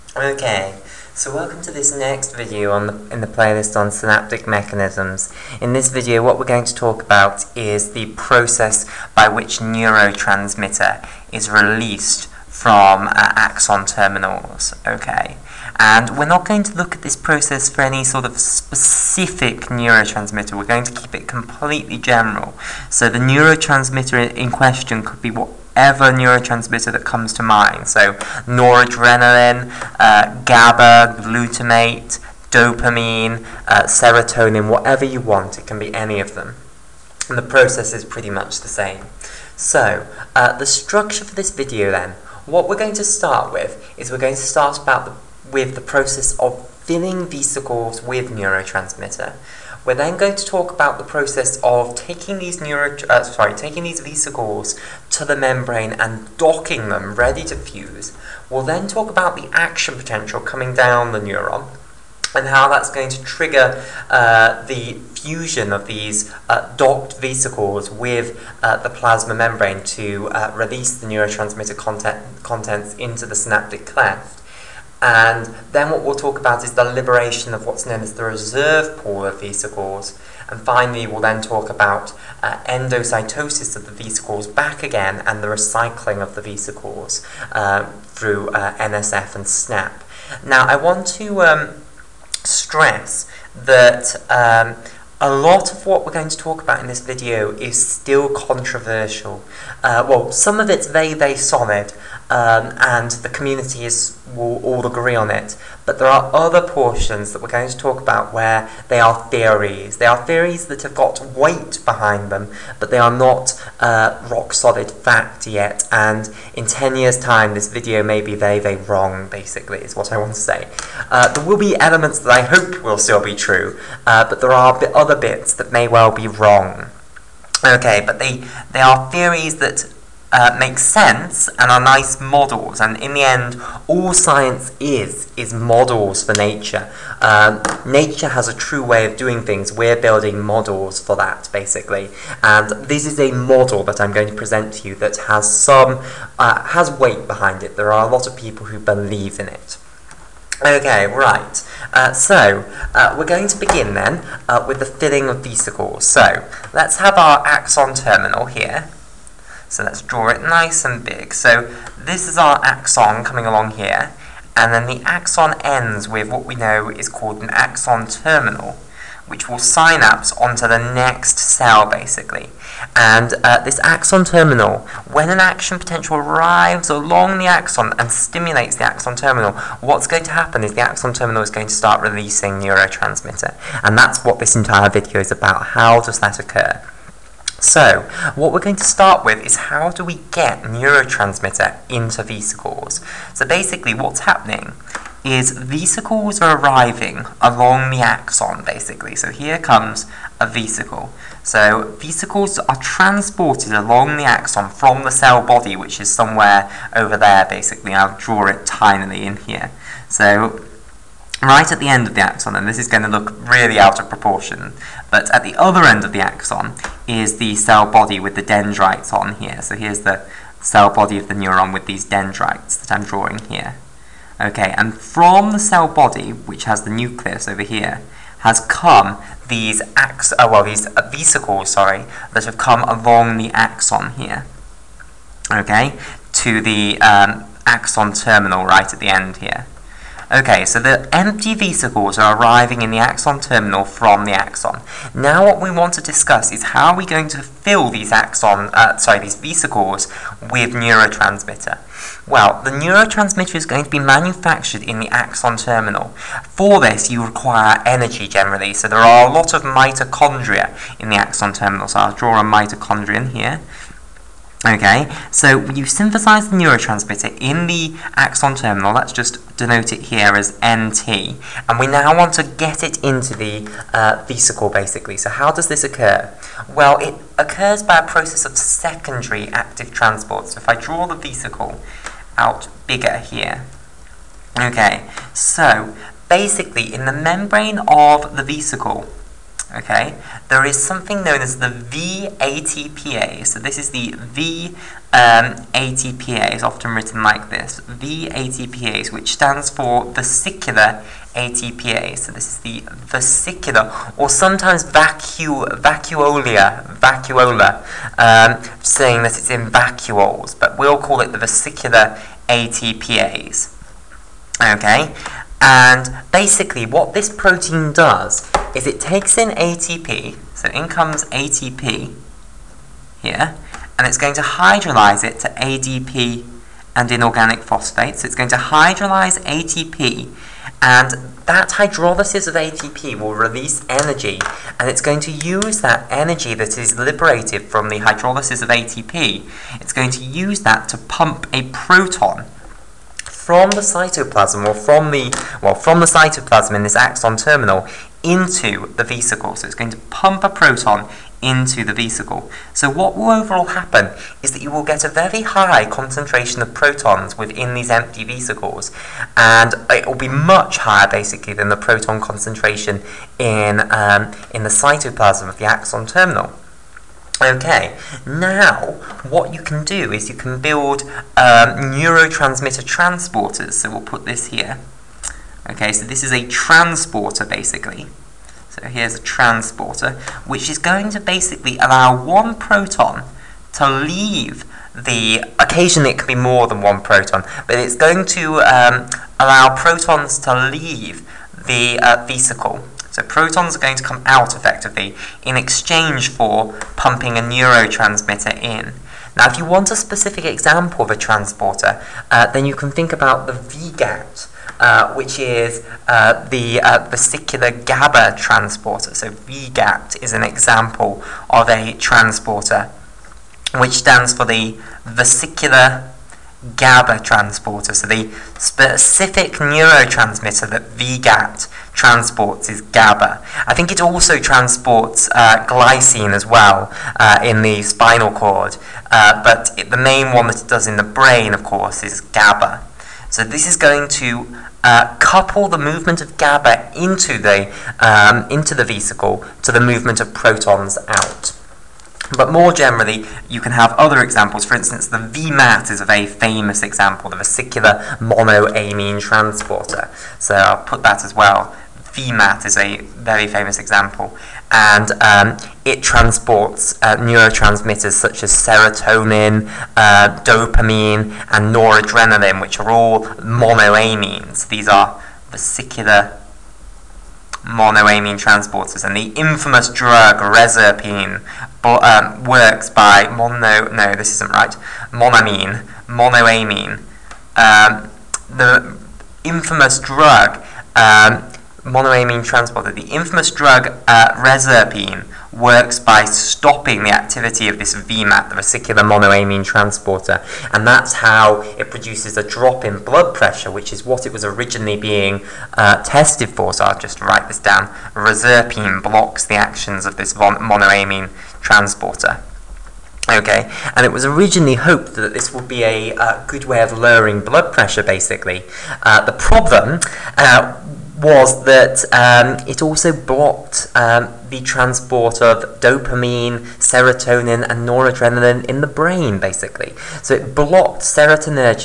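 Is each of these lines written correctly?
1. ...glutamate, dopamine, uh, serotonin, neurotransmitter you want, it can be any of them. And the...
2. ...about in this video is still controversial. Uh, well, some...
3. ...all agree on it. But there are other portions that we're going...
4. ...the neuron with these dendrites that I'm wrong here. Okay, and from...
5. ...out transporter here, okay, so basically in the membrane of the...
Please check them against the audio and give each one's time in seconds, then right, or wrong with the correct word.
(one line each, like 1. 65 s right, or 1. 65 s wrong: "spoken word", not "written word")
1. 31 s wrong: "whatever", not "neurotransmitter"
2. 96 s right
3. 104 s right
4. 221 s wrong: "drawing", not "wrong"
5. 282 s wrong: "bigger", not "transporter".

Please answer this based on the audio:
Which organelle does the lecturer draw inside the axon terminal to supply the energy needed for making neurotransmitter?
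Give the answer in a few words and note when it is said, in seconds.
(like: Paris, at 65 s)
Mitochondrion, at 262 s.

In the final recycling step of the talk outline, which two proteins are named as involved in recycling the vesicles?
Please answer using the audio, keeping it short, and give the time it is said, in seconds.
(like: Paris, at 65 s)
NSF and SNAP, at 88 s.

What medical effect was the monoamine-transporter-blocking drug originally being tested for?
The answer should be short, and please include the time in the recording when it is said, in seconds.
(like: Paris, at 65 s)
Drop in blood pressure, at 492 s.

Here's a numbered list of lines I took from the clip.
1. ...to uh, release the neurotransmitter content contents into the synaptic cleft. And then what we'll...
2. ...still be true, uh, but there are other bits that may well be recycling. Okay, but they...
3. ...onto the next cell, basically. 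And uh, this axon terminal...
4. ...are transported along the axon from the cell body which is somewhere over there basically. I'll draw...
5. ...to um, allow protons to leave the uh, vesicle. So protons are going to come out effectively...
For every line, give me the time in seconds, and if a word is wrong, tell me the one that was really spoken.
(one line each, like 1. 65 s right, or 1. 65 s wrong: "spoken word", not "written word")
1. 69 s right
2. 122 s wrong: "wrong", not "recycling"
3. 170 s right
4. 202 s right
5. 388 s right.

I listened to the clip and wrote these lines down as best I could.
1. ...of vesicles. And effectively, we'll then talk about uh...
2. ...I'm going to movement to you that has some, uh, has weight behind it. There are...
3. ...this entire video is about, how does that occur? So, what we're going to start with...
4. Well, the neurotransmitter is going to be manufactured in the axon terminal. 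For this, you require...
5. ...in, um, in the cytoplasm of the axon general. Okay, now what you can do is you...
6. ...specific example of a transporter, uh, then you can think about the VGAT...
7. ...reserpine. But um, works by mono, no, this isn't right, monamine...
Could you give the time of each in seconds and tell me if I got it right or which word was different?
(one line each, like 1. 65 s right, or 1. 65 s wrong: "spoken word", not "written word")
1. 79 s wrong: "finally", not "effectively"
2. 144 s wrong: "present", not "movement"
3. 184 s right
4. 252 s right
5. 363 s wrong: "terminal", not "general"
6. 399 s right
7. 470 s right.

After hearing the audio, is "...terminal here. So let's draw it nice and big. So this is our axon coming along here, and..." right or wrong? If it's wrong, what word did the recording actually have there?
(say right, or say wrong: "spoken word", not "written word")
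right.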